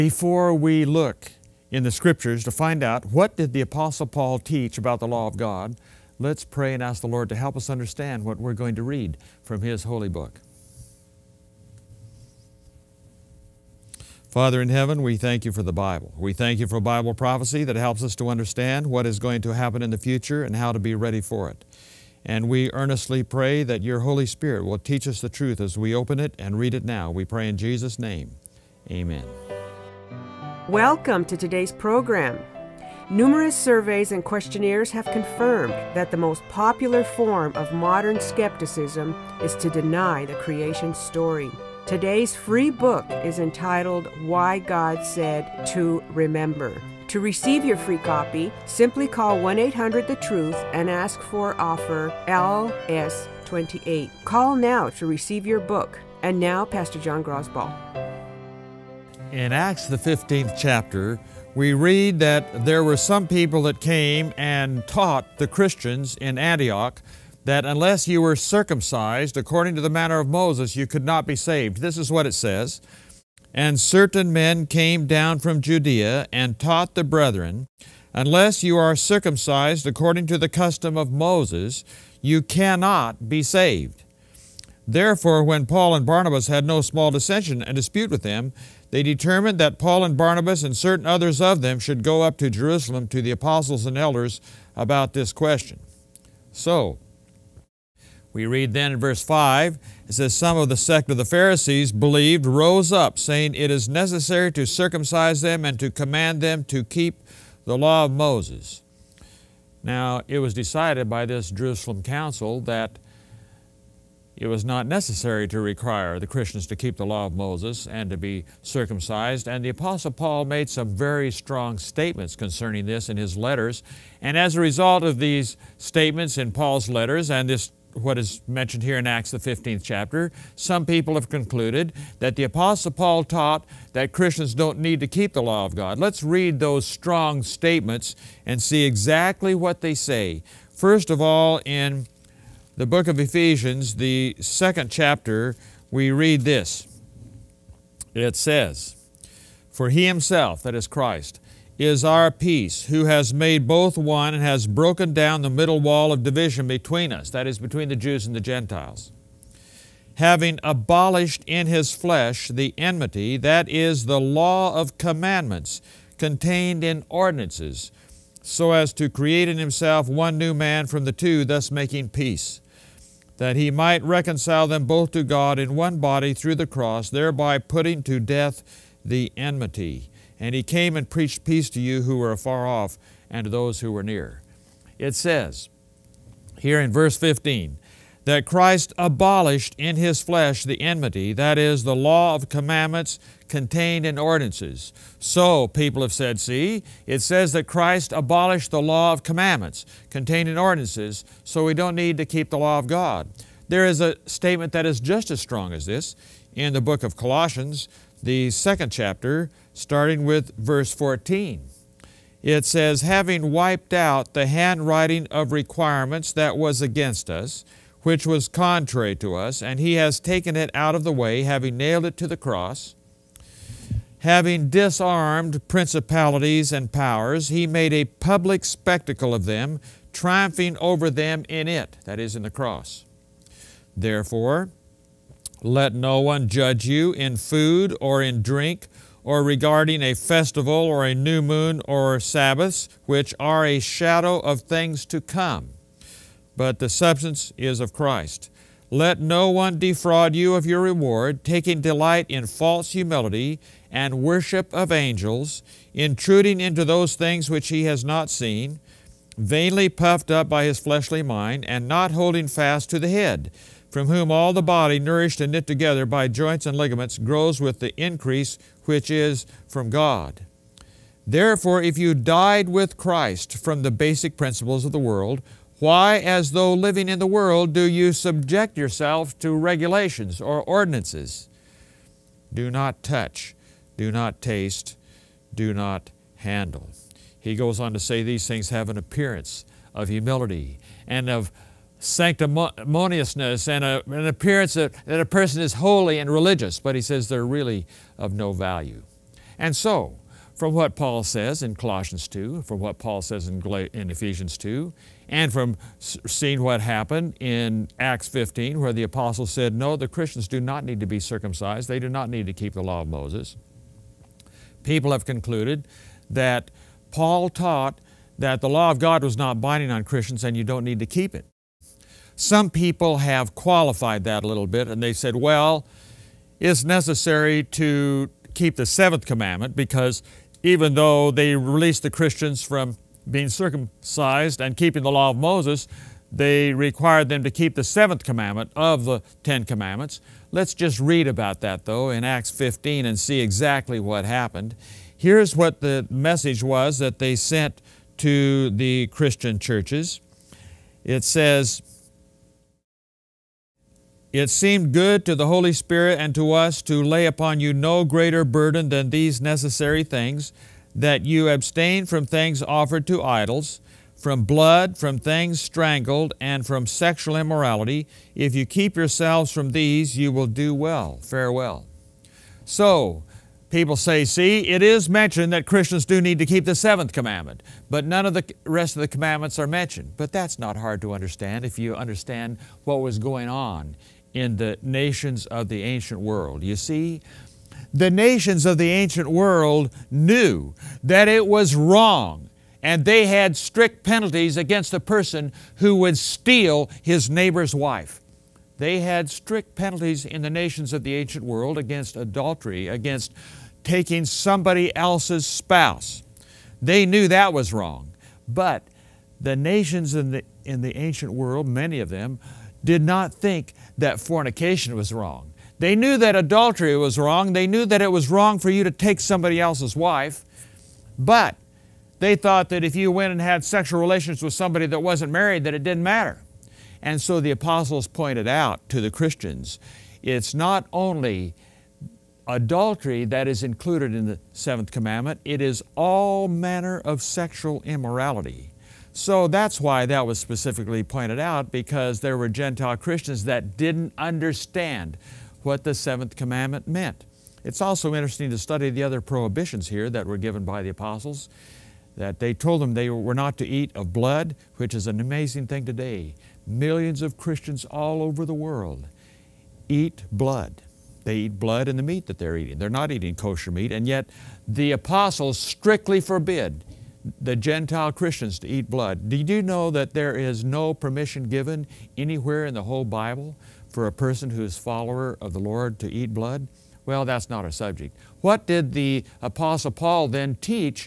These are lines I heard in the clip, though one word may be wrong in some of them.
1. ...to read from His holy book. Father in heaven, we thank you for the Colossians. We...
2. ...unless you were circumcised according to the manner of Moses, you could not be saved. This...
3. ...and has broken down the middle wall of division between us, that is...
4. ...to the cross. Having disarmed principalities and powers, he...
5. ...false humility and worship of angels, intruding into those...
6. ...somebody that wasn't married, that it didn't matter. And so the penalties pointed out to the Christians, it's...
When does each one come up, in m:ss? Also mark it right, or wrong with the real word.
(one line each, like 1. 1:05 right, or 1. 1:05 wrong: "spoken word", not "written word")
1. 0:08 wrong: "Bible", not "Colossians"
2. 1:07 right
3. 2:34 right
4. 3:42 right
5. 4:12 right
6. 7:04 wrong: "apostles", not "penalties".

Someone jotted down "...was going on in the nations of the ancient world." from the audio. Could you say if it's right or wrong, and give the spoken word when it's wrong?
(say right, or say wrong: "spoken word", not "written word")
right.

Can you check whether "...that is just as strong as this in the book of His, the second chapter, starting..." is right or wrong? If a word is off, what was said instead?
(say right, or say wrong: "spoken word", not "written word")
wrong: "Colossians", not "His".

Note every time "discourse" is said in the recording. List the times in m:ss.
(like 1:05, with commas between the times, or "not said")
not said.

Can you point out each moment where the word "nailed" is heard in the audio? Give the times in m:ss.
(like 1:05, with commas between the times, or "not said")
3:41.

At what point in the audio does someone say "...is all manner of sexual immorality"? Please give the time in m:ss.
7:15.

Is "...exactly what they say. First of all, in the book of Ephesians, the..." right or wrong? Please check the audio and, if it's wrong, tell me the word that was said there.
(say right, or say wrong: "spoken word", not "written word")
right.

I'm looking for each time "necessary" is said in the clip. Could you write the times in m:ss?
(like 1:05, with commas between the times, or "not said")
1:43, 1:54, 5:26, 5:59.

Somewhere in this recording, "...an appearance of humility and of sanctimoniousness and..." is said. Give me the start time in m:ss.
4:48.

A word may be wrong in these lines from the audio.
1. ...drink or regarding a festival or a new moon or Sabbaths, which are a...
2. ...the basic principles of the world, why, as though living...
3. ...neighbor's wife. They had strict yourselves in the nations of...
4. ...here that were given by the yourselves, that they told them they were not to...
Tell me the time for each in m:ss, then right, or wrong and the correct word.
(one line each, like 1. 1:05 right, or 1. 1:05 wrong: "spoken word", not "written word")
1. 3:58 right
2. 4:33 right
3. 6:37 wrong: "penalties", not "yourselves"
4. 7:29 wrong: "apostles", not "yourselves".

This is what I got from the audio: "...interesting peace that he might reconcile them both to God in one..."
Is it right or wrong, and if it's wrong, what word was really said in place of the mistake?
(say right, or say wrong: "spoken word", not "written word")
wrong: "making", not "interesting".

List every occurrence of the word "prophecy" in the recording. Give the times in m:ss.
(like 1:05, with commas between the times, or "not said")
0:17.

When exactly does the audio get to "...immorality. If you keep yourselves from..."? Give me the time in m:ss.
6:07.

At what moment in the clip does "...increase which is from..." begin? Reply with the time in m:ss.
4:28.